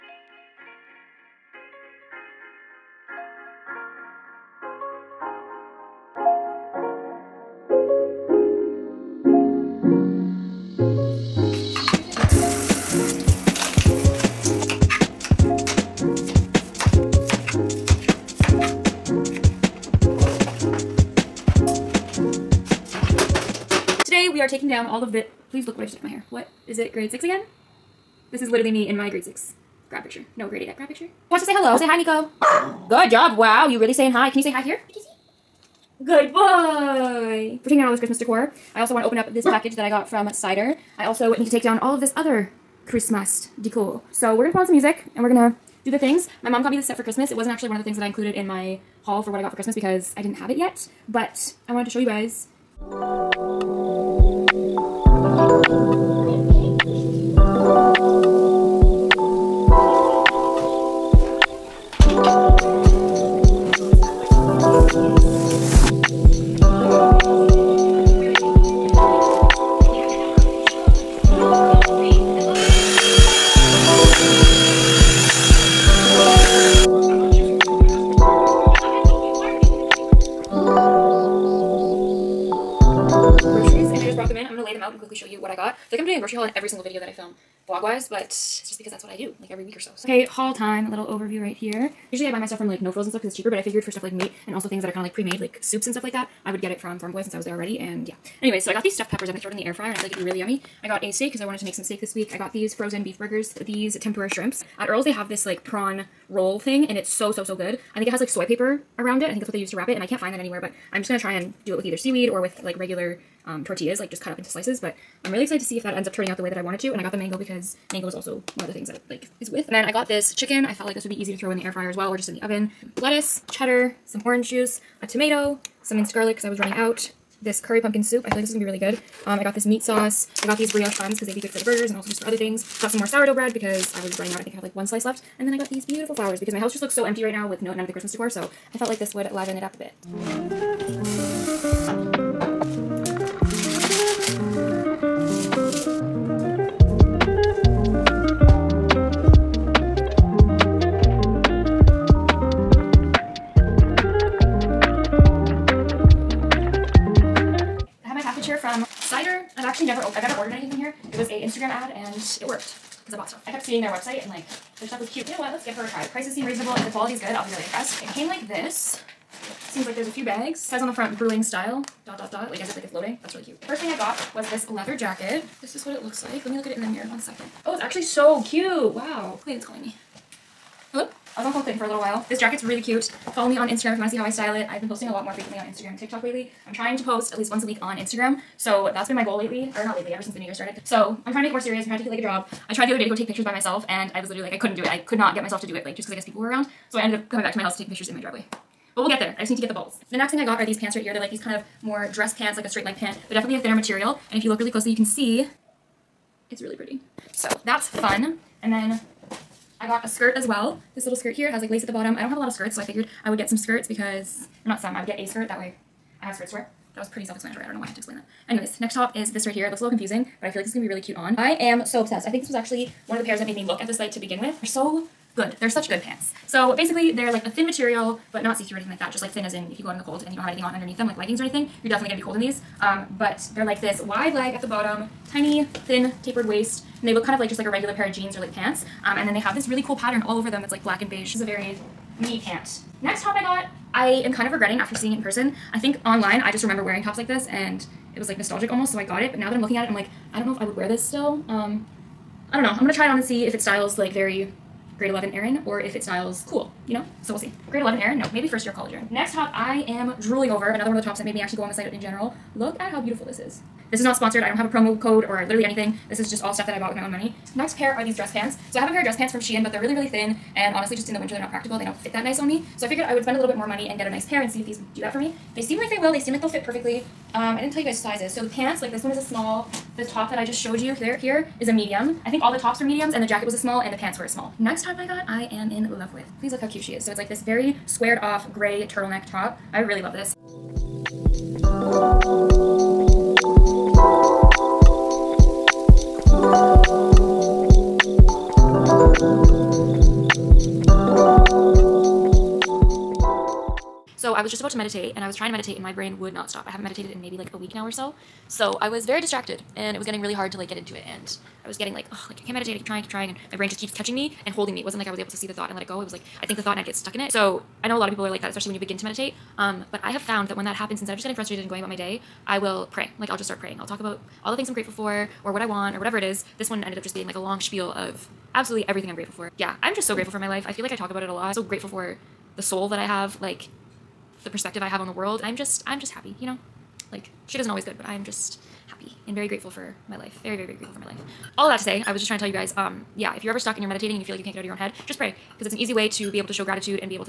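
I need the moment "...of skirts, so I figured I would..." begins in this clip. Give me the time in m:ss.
3:32.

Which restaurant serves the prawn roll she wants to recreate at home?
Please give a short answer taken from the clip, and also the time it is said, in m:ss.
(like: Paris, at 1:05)
Earl's, at 1:44.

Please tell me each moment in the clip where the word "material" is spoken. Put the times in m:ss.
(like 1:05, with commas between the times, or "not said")
3:23, 3:47.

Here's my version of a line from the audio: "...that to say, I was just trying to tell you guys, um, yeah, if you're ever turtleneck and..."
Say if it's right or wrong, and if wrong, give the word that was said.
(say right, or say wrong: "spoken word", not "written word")
wrong: "stuck", not "turtleneck".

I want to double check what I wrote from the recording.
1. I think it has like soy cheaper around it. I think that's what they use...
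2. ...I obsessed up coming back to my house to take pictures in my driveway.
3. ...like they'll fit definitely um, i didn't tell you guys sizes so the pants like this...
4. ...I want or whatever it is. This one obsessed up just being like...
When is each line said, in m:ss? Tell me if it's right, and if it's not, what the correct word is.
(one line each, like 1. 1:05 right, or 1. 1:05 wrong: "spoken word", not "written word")
1. 1:47 wrong: "paper", not "cheaper"
2. 3:16 wrong: "ended", not "obsessed"
3. 4:36 wrong: "perfectly", not "definitely"
4. 5:25 wrong: "ended", not "obsessed".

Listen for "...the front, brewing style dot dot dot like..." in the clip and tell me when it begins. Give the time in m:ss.
2:50.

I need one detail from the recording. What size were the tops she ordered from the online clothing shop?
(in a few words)
medium.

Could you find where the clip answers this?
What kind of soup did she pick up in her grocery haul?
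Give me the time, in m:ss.
2:07.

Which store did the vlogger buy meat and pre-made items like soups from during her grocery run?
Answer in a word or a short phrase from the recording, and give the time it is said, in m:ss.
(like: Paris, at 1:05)
Farm Boy, at 1:36.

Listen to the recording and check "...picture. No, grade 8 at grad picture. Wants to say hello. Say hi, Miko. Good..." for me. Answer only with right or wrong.
right.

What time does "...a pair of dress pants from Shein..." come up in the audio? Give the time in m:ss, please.
4:28.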